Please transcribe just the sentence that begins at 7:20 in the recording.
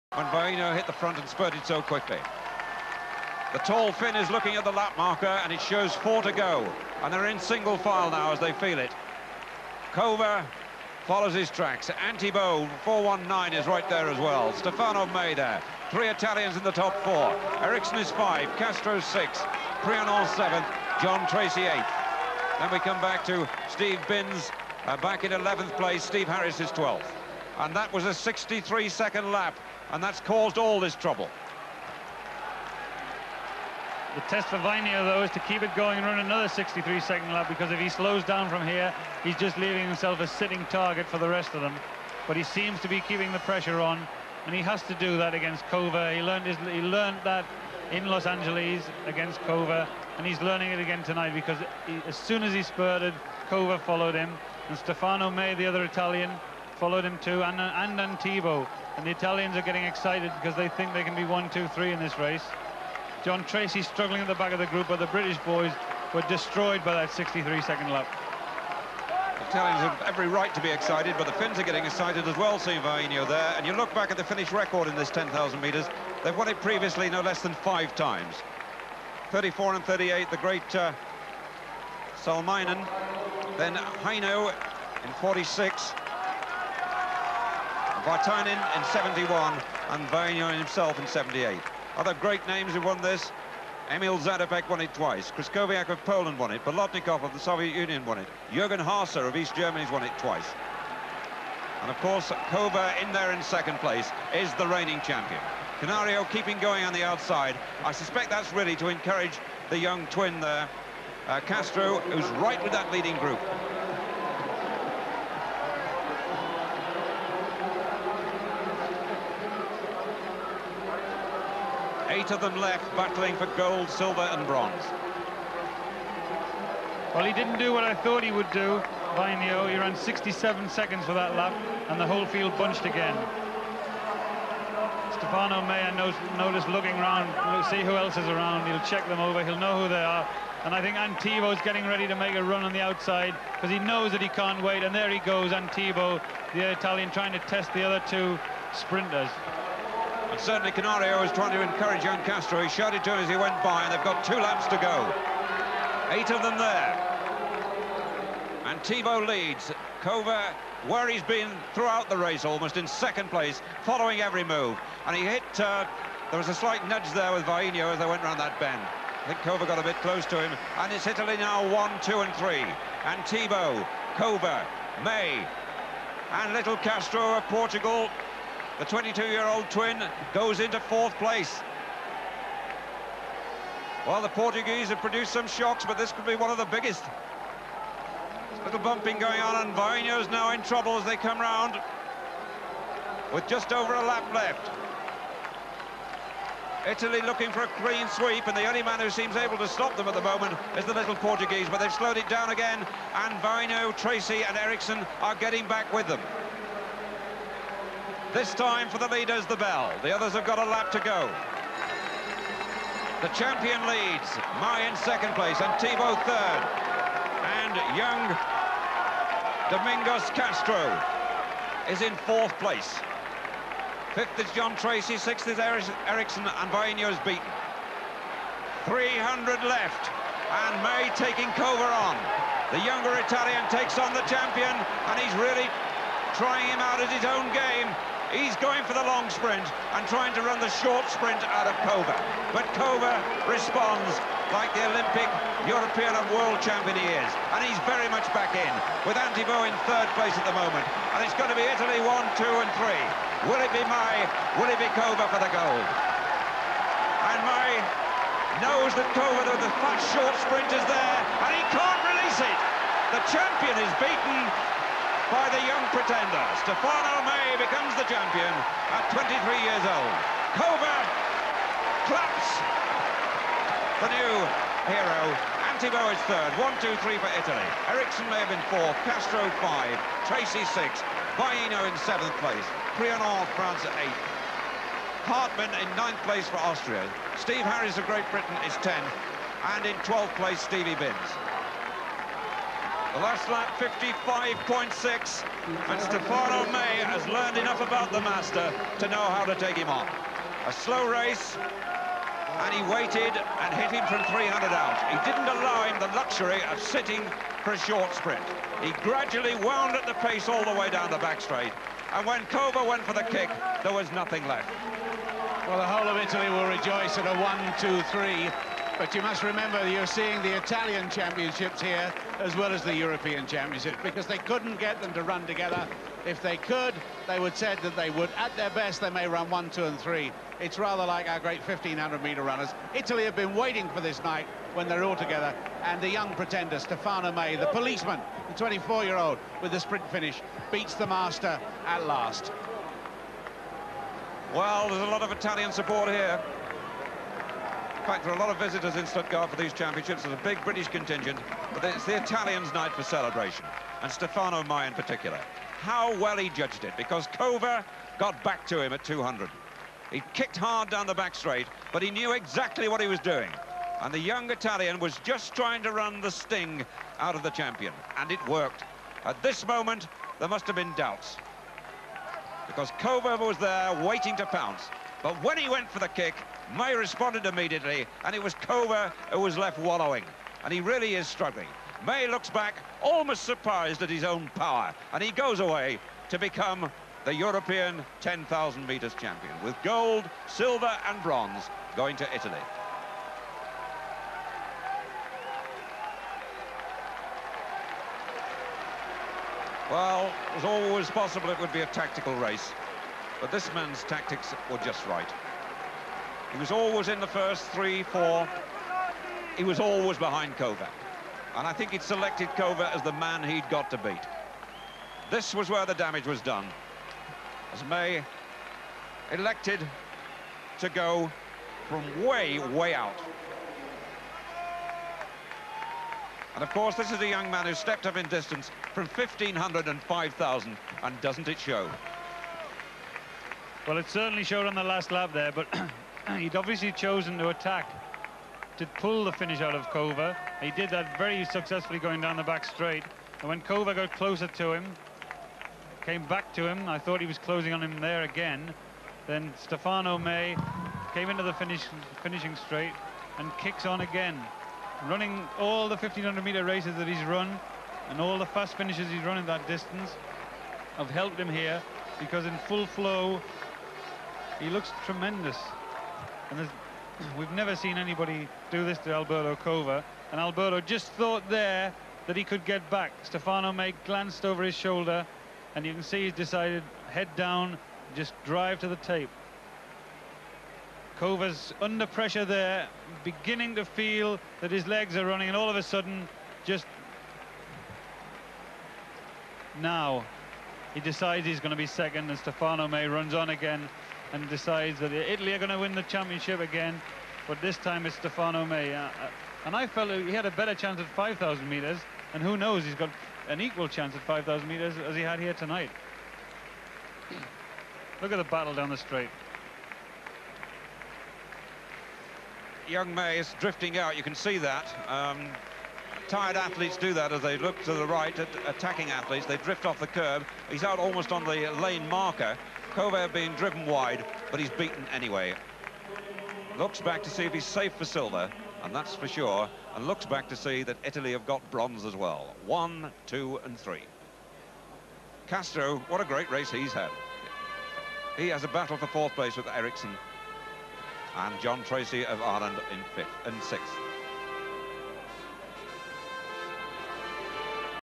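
He did that very successfully going down the back straight.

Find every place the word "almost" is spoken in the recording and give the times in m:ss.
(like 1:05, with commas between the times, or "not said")
2:42, 6:23, 8:40.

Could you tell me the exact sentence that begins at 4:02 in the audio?
But Cova responds like the Olympic, European and world champion he is.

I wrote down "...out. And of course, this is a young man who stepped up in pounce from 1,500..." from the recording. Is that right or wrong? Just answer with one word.
wrong.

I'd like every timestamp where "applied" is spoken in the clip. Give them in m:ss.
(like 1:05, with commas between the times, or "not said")
not said.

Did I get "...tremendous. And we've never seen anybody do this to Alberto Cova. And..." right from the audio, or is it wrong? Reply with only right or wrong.
right.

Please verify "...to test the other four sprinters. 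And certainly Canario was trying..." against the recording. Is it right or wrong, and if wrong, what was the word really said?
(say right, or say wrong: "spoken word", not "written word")
wrong: "two", not "four".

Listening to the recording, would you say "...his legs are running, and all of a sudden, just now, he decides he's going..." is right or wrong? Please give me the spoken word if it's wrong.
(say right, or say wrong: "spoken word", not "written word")
right.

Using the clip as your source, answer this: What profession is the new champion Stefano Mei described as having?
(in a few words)
policeman.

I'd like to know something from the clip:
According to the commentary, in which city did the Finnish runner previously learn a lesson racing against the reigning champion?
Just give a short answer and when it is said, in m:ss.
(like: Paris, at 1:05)
Los Angeles, at 0:48.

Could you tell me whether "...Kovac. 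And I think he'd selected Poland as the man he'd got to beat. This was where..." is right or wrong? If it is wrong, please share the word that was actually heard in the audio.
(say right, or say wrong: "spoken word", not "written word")
wrong: "Kovac", not "Poland".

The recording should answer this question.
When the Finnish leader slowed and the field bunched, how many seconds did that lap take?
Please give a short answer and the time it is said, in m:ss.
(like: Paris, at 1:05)
67 seconds, at 2:09.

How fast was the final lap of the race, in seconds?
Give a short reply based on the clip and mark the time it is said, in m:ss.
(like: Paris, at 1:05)
55.6, at 4:53.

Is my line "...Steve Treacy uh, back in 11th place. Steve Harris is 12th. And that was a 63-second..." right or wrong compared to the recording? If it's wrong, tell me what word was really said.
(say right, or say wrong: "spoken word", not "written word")
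wrong: "Binns", not "Treacy".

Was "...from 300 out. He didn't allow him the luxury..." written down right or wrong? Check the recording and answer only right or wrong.
right.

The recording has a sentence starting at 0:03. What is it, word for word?
The tall Finn is looking at the lap marker and it shows four to go.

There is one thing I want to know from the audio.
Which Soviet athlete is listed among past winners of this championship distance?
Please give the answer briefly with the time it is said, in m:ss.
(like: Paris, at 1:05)
Bolotnikov, at 1:36.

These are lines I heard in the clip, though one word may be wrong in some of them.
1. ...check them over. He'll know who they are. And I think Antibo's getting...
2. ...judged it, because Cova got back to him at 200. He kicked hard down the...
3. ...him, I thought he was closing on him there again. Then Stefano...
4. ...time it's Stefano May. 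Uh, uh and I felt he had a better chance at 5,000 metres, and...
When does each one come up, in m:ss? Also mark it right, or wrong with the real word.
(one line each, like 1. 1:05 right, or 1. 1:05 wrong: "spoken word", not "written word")
1. 2:18 right
2. 5:56 right
3. 7:26 right
4. 8:17 right.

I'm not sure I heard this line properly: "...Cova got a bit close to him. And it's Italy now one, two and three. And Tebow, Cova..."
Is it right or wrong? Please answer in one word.
right.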